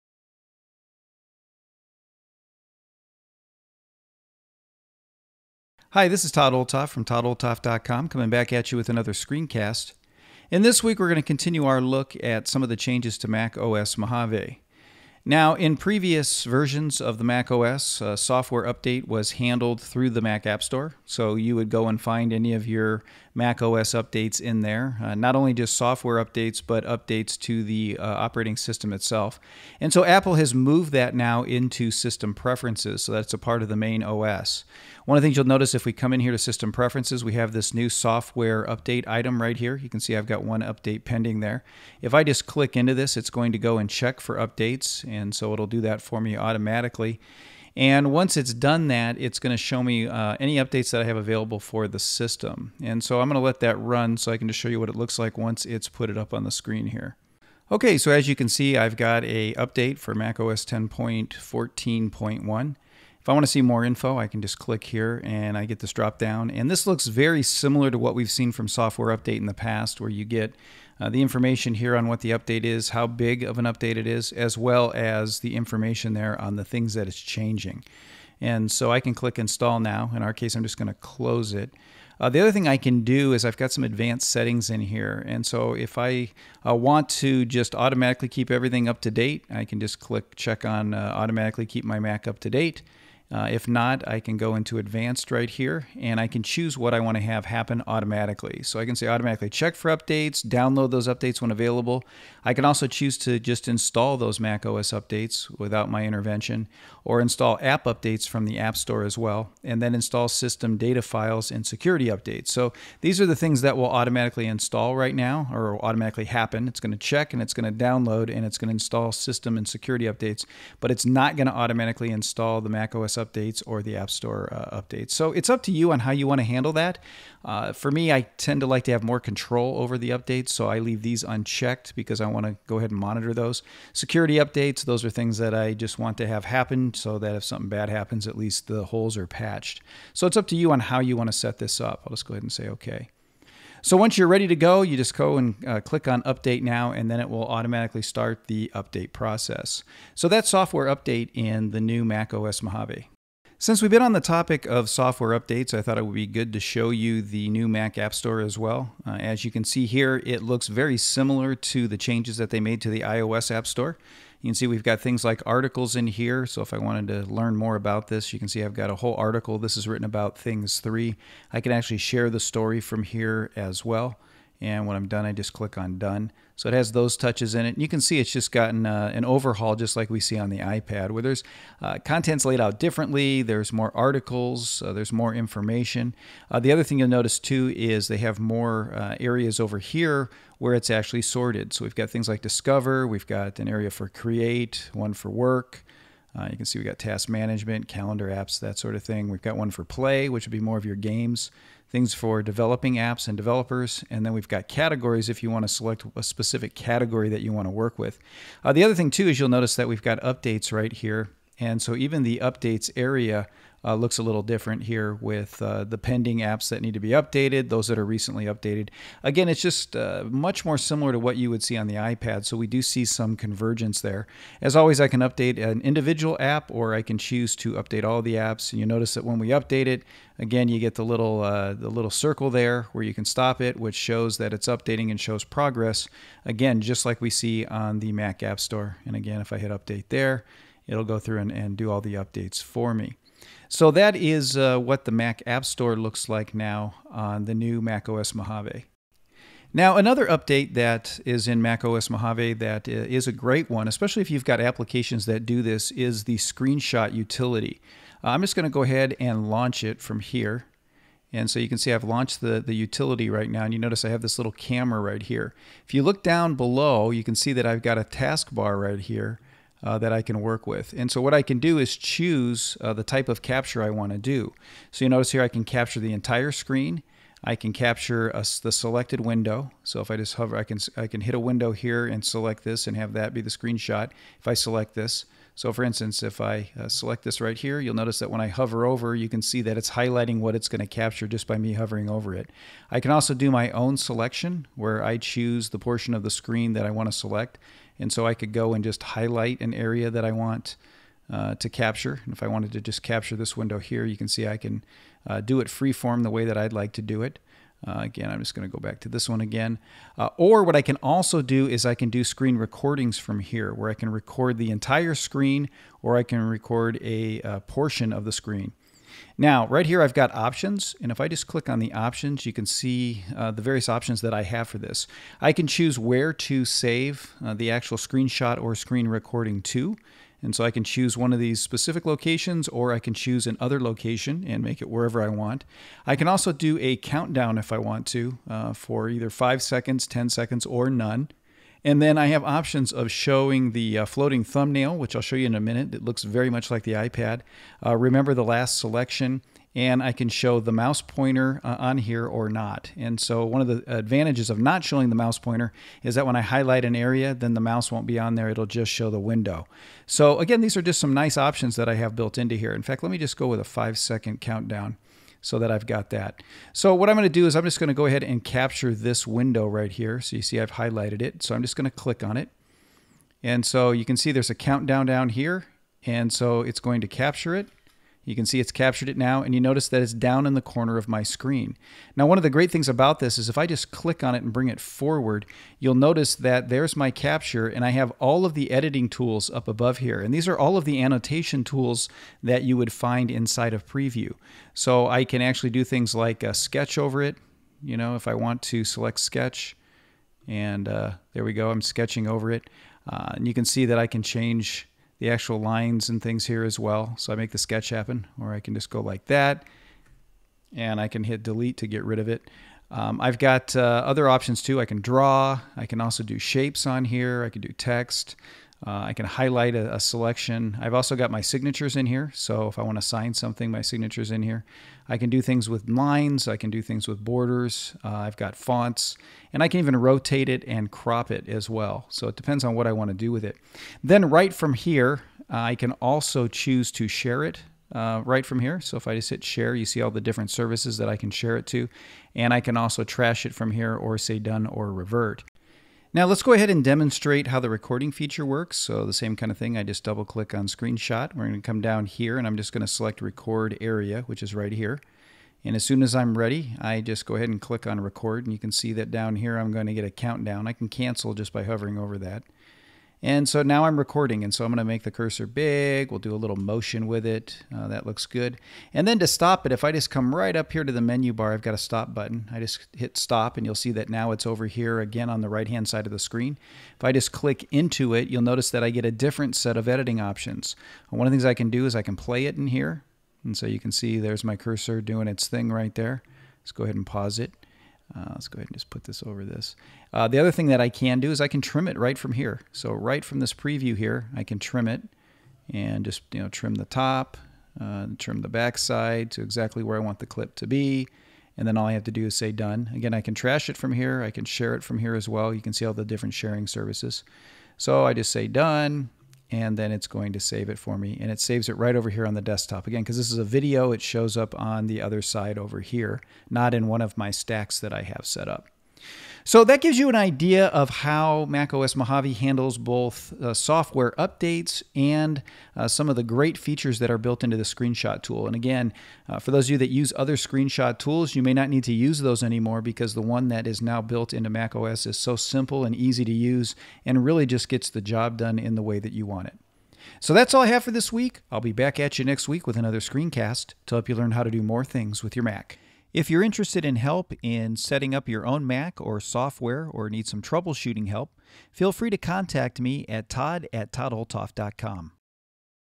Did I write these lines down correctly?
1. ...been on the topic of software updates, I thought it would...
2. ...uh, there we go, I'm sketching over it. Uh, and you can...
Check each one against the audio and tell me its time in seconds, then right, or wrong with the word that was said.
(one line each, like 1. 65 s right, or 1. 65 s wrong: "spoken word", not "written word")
1. 153 s right
2. 400 s right.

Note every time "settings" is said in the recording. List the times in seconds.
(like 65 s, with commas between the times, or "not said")
84 s, 547 s.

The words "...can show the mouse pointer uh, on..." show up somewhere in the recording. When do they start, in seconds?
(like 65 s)
350 s.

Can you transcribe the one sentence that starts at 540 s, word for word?
So that's all I have for this week.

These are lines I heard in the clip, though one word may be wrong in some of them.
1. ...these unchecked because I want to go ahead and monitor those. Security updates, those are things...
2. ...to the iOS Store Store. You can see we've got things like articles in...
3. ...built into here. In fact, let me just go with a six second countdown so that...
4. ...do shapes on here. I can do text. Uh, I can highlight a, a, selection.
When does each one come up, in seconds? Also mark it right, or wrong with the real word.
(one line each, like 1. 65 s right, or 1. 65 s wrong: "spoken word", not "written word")
1. 131 s right
2. 162 s wrong: "App", not "Store"
3. 362 s wrong: "five", not "six"
4. 416 s right.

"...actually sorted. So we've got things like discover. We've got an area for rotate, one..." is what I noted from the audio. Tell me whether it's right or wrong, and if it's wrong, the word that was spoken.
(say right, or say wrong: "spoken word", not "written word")
wrong: "create", not "rotate".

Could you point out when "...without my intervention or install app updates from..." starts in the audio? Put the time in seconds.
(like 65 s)
105 s.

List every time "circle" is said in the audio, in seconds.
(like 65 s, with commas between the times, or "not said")
232 s.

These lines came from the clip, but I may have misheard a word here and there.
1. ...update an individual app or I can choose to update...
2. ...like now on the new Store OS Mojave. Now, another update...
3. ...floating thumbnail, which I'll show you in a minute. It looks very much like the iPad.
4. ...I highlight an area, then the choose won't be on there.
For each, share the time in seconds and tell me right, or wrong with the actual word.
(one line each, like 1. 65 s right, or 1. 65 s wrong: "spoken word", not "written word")
1. 225 s right
2. 246 s wrong: "Mac", not "Store"
3. 344 s right
4. 356 s wrong: "mouse", not "choose".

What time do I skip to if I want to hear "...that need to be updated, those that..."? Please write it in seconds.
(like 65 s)
216 s.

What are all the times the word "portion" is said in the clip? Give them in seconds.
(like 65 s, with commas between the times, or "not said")
295 s, 317 s.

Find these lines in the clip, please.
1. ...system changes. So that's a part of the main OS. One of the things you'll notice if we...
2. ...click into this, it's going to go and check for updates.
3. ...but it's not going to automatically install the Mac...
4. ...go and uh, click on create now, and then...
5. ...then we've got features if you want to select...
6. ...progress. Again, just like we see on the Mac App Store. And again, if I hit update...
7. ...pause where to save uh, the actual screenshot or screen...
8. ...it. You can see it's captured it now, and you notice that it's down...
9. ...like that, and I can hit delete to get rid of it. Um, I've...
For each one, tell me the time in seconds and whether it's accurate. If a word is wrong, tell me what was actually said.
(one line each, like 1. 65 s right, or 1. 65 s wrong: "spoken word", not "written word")
1. 31 s wrong: "preferences", not "changes"
2. 42 s right
3. 120 s right
4. 145 s wrong: "update", not "create"
5. 204 s wrong: "categories", not "features"
6. 235 s right
7. 325 s wrong: "choose", not "pause"
8. 377 s right
9. 409 s right.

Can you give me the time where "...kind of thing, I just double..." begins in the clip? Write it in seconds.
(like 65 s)
449 s.